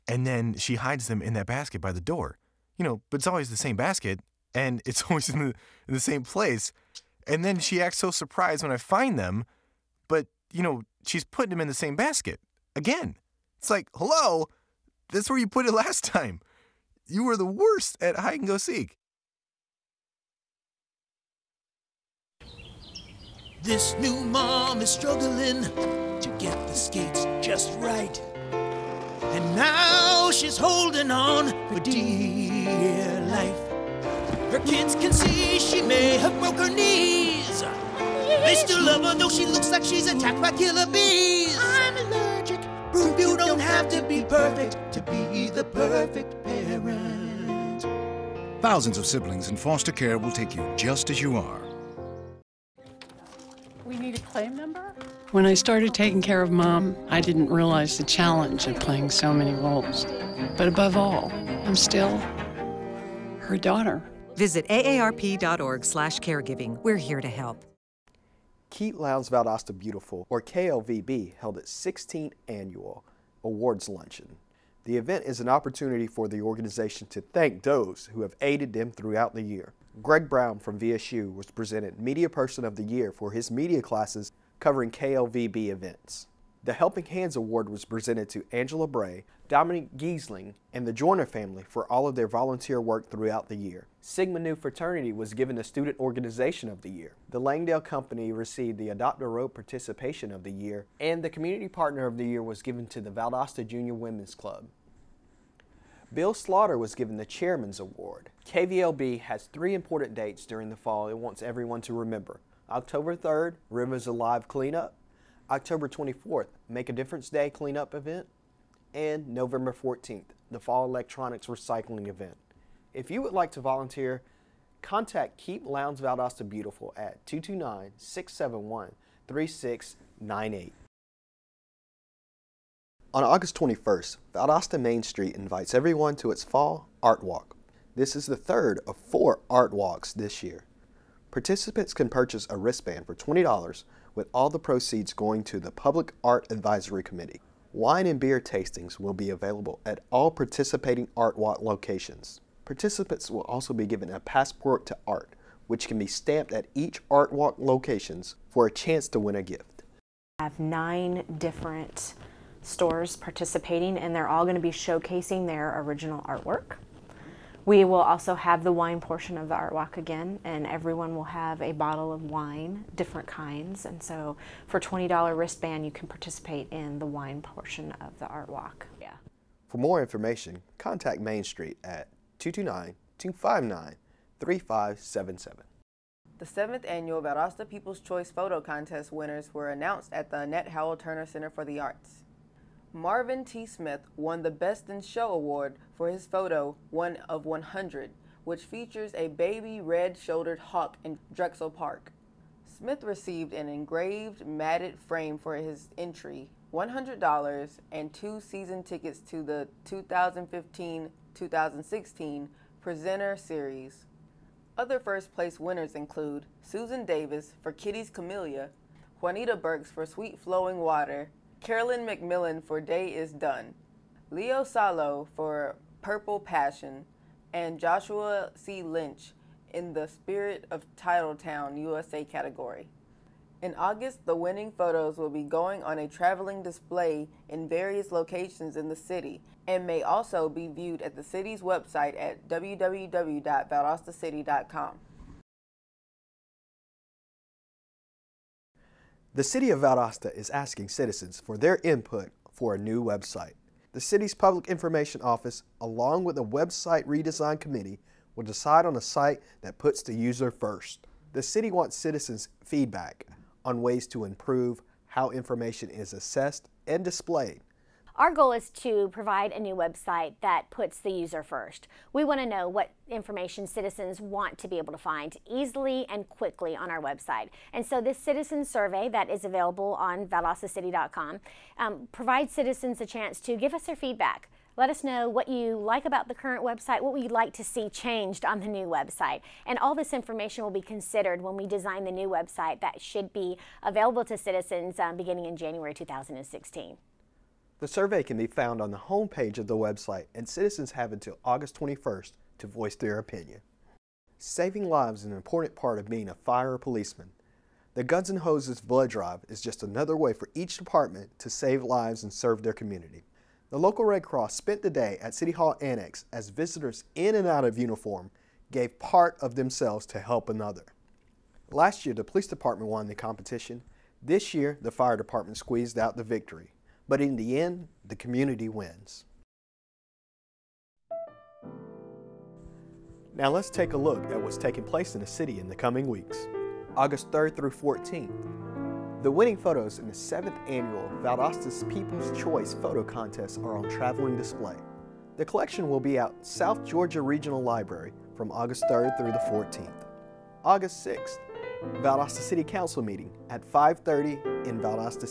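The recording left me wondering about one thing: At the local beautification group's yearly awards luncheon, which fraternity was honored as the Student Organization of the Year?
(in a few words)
Sigma Nu.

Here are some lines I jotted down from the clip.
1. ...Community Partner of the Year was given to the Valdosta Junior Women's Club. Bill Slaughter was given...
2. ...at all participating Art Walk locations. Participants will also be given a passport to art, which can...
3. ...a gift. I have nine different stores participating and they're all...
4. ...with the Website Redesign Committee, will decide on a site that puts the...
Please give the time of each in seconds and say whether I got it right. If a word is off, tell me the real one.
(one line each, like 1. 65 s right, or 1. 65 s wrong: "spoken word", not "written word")
1. 101 s right
2. 149 s right
3. 159 s right
4. 256 s right.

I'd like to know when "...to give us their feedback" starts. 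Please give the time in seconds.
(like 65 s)
283 s.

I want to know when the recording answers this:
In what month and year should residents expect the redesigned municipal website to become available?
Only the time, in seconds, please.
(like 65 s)
295 s.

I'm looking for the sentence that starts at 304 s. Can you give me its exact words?
Saving lives is an important part of being a fire policeman.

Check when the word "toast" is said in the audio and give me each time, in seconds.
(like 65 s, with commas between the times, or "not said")
not said.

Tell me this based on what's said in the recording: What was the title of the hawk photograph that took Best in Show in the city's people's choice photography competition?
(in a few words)
One of 100.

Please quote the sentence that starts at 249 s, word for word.
The City of Valdosta is asking citizens for their input for a new website.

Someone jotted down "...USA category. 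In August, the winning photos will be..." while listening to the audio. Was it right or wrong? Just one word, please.
right.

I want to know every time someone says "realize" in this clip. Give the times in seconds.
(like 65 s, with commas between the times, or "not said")
57 s.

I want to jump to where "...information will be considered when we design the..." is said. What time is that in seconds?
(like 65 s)
290 s.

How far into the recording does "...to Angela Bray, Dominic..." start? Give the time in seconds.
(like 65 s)
88 s.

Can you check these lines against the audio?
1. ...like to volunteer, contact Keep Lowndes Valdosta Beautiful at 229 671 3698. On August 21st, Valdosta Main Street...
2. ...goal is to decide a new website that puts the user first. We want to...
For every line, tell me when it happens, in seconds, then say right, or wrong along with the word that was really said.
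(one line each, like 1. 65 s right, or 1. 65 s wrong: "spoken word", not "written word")
1. 123 s right
2. 268 s wrong: "provide", not "decide".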